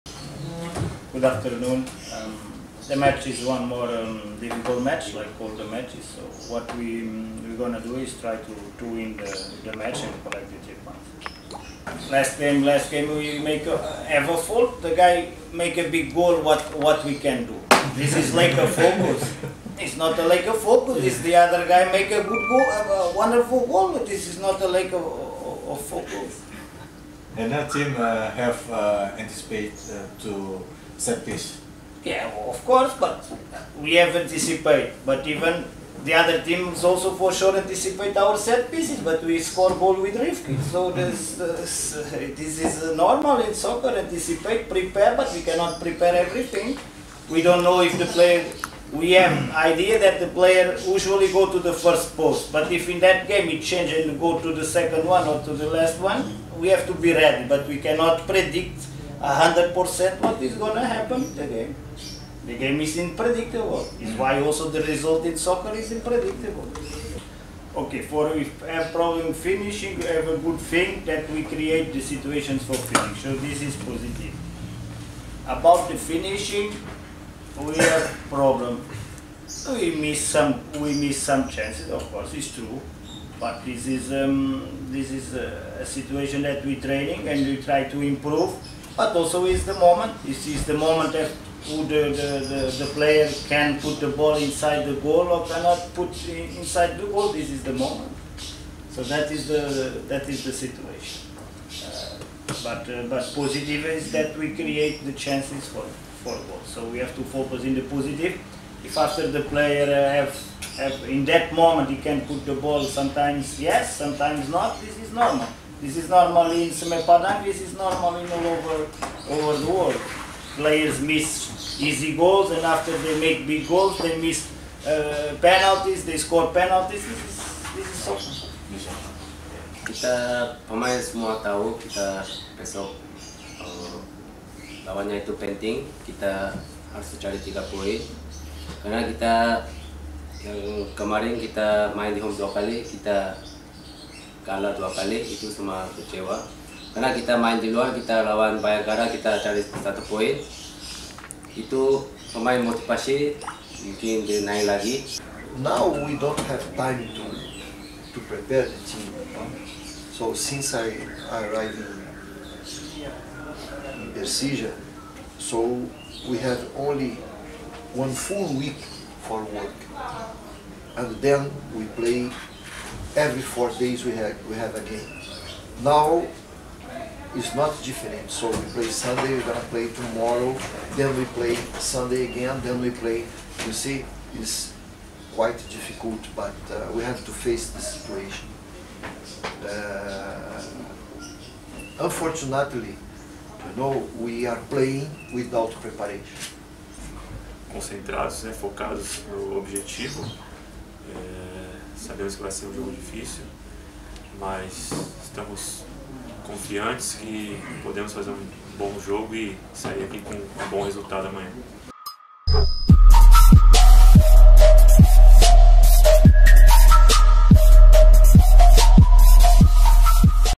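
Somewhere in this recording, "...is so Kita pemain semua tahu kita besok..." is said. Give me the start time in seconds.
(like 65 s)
127 s.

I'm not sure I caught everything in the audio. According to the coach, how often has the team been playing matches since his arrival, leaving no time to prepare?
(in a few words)
every 4 days.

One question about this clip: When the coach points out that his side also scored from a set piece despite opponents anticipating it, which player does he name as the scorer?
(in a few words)
Rifkin.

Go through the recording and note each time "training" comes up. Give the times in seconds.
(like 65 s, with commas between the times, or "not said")
86 s.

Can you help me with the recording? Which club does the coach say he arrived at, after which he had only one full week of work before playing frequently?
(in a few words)
Persija.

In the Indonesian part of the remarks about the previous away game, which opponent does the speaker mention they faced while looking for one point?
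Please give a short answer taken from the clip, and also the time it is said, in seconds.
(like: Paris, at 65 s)
Bayangkara, at 148 s.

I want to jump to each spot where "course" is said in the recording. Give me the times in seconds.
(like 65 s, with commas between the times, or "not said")
32 s, 82 s.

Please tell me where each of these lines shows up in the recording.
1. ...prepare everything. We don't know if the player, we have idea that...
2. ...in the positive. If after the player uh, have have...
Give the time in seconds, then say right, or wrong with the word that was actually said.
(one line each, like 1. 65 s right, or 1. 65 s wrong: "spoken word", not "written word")
1. 45 s right
2. 107 s right.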